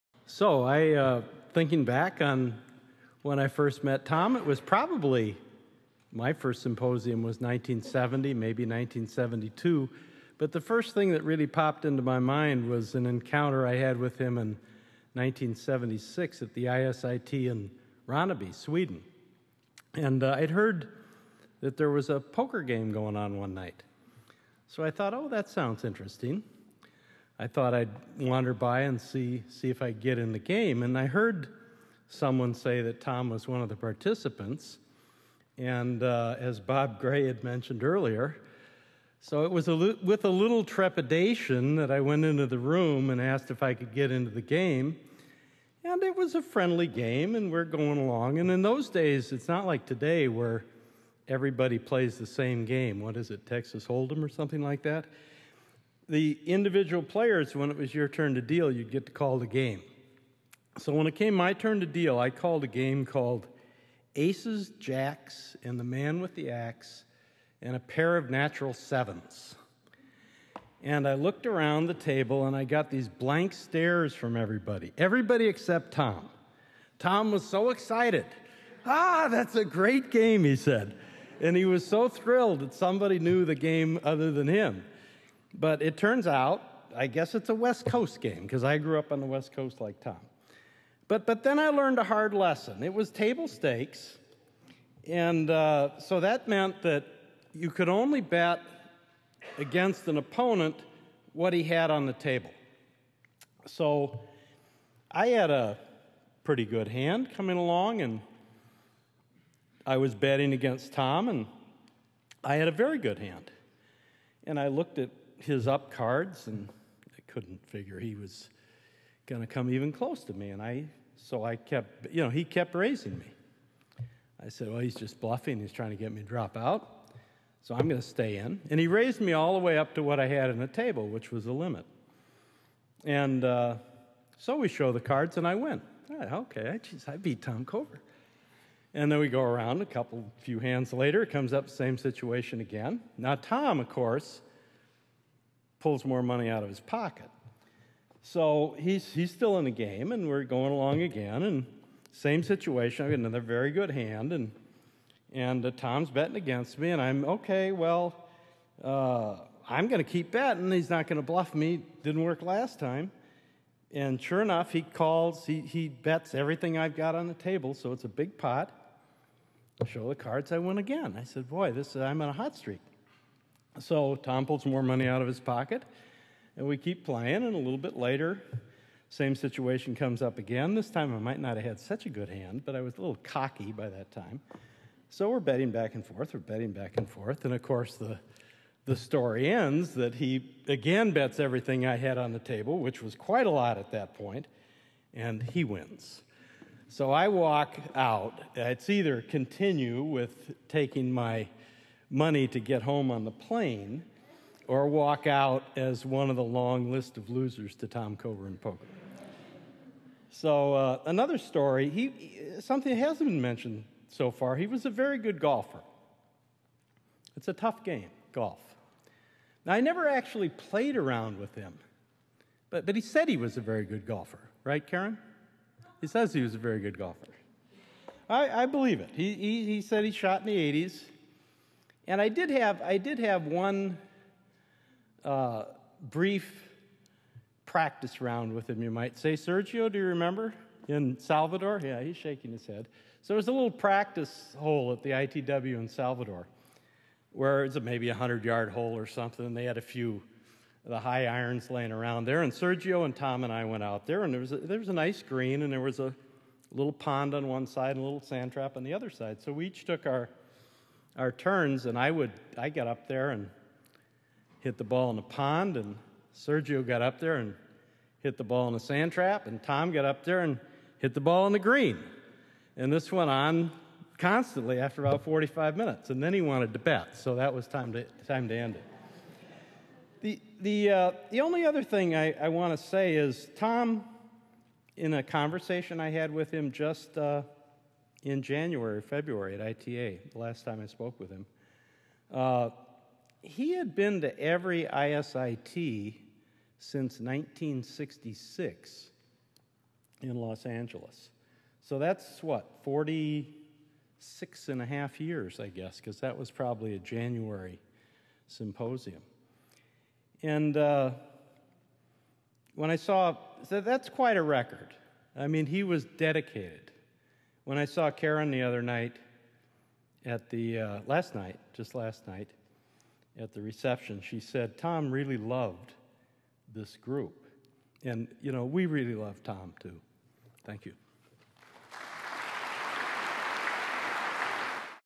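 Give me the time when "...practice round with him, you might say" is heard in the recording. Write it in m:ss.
3:57.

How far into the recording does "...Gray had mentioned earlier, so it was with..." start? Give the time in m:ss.
0:36.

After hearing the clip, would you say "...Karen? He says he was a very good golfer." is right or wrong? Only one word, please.
right.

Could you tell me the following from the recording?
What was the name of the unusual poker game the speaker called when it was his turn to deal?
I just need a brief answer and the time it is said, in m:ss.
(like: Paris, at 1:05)
Aces, Jacks, and the Man with the Axe, at 1:04.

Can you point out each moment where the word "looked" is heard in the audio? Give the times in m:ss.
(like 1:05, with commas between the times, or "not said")
1:11, 1:54.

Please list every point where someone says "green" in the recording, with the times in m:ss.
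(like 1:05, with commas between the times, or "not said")
4:15, 4:31.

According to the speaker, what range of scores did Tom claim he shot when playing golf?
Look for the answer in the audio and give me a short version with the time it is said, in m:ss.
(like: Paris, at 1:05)
the 80s, at 3:50.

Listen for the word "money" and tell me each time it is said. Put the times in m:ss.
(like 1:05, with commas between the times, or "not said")
2:26, 2:54, 3:22.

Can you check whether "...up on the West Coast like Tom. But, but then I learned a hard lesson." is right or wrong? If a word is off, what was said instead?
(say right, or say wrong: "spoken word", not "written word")
right.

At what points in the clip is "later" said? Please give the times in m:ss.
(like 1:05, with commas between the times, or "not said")
2:20, 2:57.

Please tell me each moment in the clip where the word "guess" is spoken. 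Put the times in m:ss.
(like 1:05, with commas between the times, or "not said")
1:27, 5:05.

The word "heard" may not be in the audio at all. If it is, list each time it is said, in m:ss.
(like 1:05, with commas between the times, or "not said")
0:20, 0:31.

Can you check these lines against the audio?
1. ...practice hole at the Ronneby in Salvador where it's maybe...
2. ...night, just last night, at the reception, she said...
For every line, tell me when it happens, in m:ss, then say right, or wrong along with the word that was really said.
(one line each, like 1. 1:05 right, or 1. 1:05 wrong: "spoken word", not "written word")
1. 4:03 wrong: "ITW", not "Ronneby"
2. 5:21 right.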